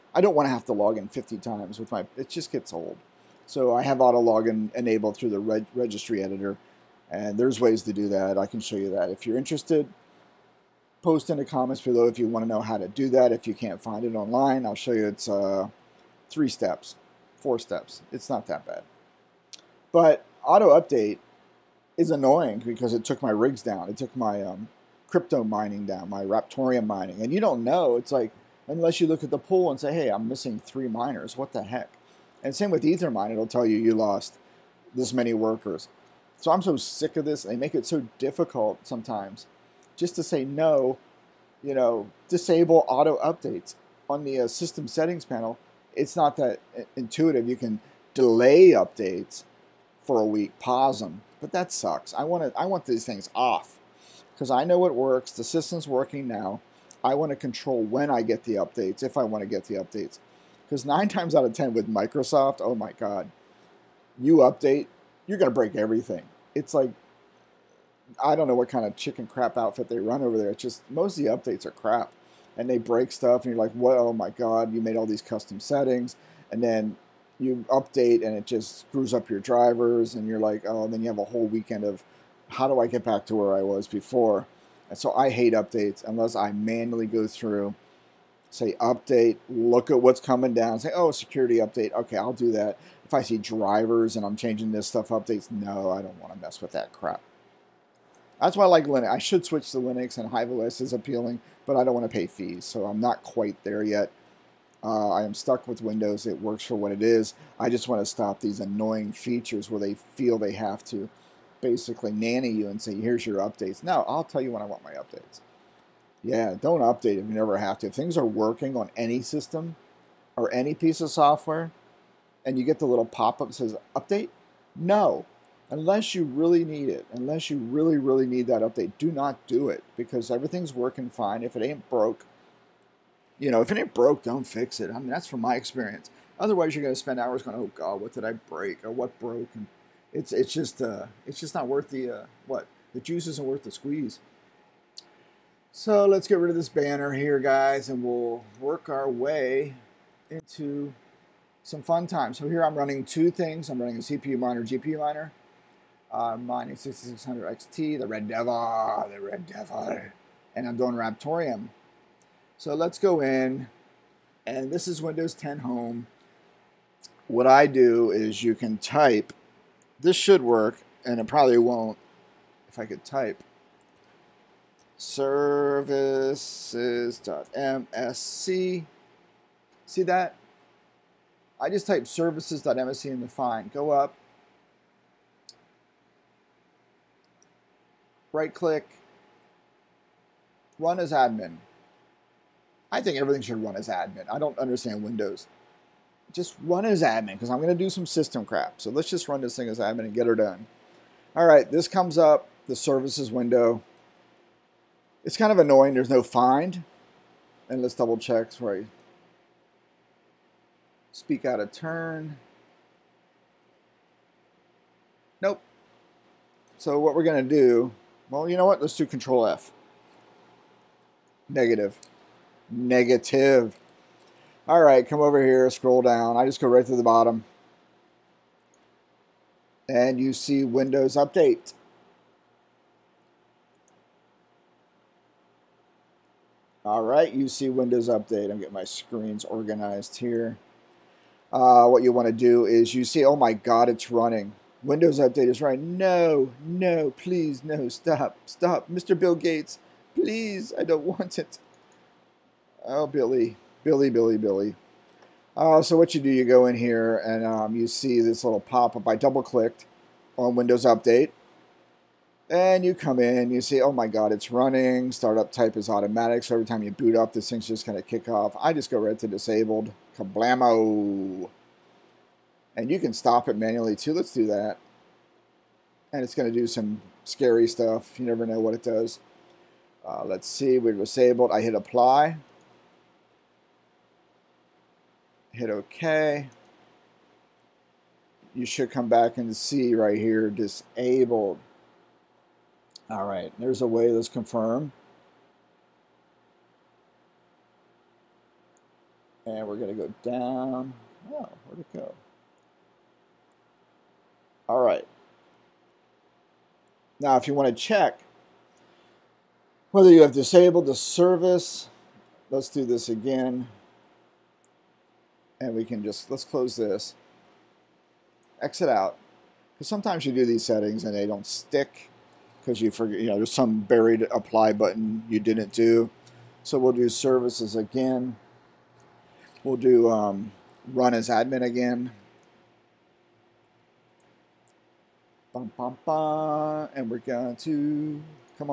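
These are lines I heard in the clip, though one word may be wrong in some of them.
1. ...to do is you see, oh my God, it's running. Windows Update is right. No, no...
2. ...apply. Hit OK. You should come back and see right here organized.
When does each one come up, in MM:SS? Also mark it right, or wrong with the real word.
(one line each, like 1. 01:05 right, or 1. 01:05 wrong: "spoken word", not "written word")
1. 04:02 right
2. 04:41 wrong: "disabled", not "organized".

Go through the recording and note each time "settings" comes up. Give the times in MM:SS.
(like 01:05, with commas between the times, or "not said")
00:44, 01:15, 05:20.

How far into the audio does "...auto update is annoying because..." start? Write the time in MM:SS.
00:20.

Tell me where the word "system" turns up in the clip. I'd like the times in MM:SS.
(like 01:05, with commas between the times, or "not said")
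00:44, 00:55, 01:59, 03:18.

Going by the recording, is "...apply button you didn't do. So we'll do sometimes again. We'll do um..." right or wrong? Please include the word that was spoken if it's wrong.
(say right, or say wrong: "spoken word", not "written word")
wrong: "services", not "sometimes".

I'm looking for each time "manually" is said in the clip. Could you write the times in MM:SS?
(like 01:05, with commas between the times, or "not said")
01:26, 04:33.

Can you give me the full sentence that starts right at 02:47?
What I do is you can type, this should work, and it probably won't if I could type services.msc.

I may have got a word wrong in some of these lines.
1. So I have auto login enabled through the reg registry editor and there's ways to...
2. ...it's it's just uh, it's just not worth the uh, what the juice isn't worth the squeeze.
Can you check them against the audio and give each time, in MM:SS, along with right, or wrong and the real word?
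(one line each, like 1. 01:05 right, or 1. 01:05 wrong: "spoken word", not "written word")
1. 00:03 right
2. 02:20 right.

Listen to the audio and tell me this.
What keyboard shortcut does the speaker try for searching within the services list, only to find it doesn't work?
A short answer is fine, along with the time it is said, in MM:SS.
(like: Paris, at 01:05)
Control F, at 03:39.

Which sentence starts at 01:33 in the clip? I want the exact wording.
If I see drivers and I'm changing this stuff updates, no, I don't want to mess with that crap.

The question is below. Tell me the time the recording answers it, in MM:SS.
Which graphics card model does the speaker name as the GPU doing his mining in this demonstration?
02:36.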